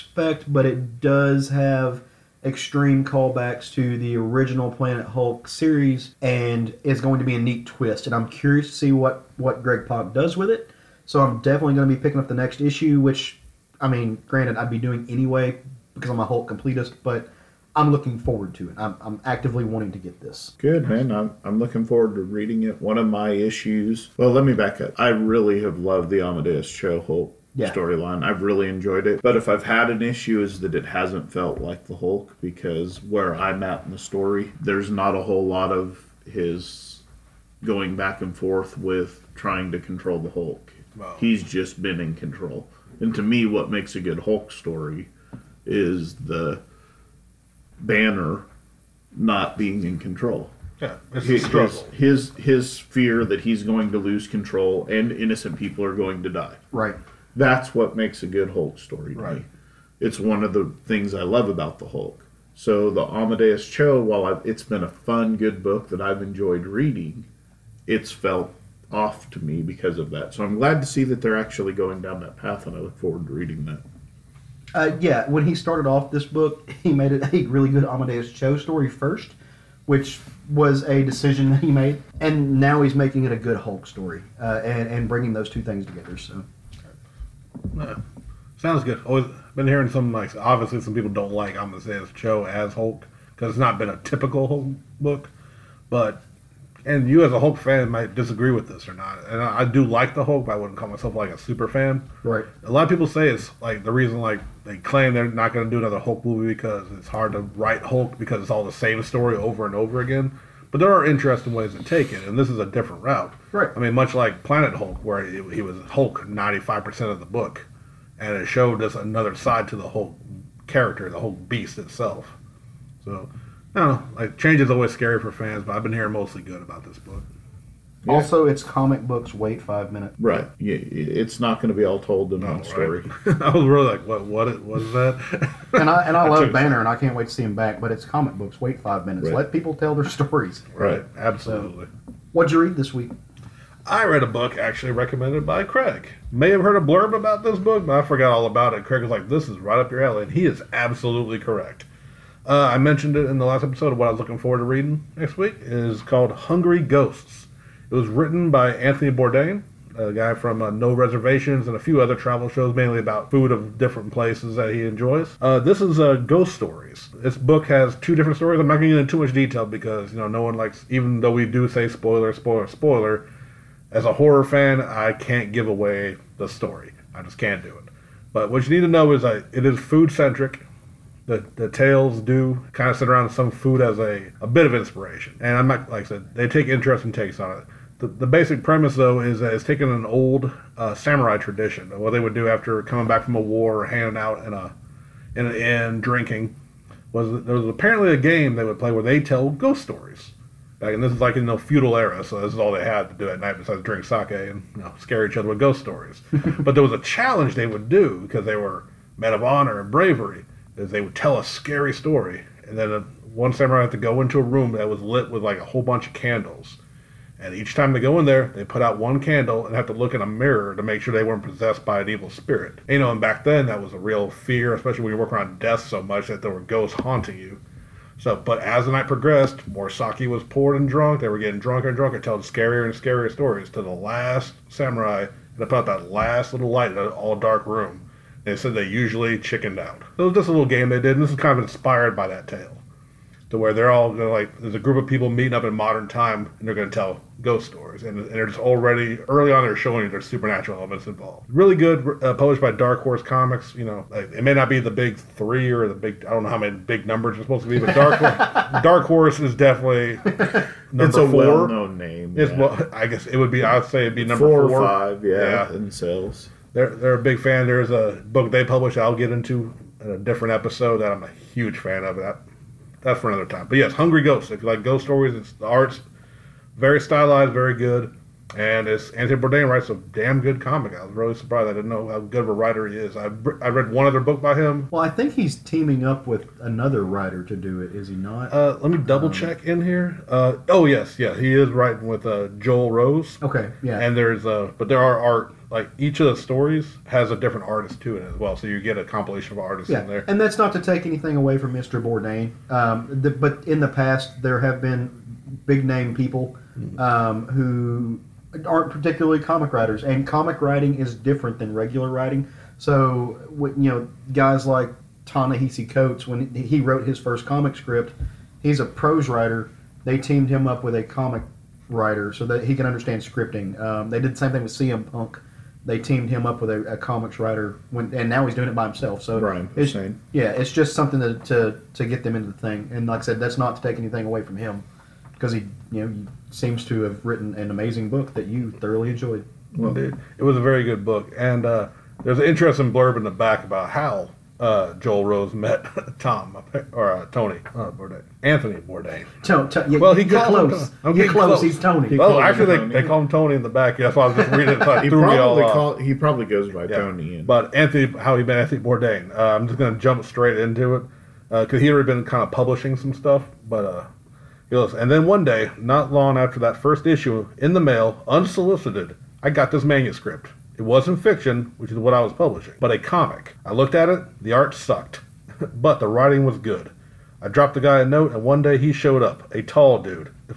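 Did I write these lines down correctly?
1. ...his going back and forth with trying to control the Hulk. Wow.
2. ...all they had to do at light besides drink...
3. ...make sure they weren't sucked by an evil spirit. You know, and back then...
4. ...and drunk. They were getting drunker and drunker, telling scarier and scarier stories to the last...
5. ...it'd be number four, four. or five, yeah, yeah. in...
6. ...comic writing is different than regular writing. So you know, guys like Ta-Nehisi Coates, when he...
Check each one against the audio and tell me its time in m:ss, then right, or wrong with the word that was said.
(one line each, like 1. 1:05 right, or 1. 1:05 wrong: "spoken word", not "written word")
1. 0:36 right
2. 3:22 wrong: "night", not "light"
3. 3:40 wrong: "possessed", not "sucked"
4. 3:50 right
5. 4:24 right
6. 5:10 right.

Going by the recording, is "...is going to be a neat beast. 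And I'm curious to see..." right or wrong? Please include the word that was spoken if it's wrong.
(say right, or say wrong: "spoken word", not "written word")
wrong: "twist", not "beast".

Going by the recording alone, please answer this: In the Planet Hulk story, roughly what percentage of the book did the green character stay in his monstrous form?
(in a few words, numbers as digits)
95%.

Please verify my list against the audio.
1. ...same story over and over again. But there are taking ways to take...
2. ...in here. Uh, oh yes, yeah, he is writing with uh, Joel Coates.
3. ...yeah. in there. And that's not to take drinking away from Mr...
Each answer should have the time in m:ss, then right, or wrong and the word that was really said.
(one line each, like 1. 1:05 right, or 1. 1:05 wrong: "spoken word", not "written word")
1. 1:48 wrong: "interesting", not "taking"
2. 4:49 wrong: "Rose", not "Coates"
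3. 4:59 wrong: "anything", not "drinking".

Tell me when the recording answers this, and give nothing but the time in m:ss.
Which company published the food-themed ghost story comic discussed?
4:12.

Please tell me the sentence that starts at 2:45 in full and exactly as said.
Uh, this is uh, Ghost Stories.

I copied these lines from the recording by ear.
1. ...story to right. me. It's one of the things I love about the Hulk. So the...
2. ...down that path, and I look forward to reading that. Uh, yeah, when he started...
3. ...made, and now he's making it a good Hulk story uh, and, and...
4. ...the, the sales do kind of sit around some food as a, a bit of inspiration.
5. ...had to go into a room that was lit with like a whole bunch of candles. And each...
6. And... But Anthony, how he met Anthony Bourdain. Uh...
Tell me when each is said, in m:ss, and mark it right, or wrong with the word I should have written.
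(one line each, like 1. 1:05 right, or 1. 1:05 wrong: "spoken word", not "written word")
1. 0:58 right
2. 1:12 right
3. 1:21 right
4. 3:01 wrong: "tales", not "sales"
5. 3:33 right
6. 5:57 right.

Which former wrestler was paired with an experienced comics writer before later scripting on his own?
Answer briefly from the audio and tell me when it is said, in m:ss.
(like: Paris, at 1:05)
CM Punk, at 5:24.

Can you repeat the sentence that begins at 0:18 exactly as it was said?
I'm, I'm actively wanting to get this.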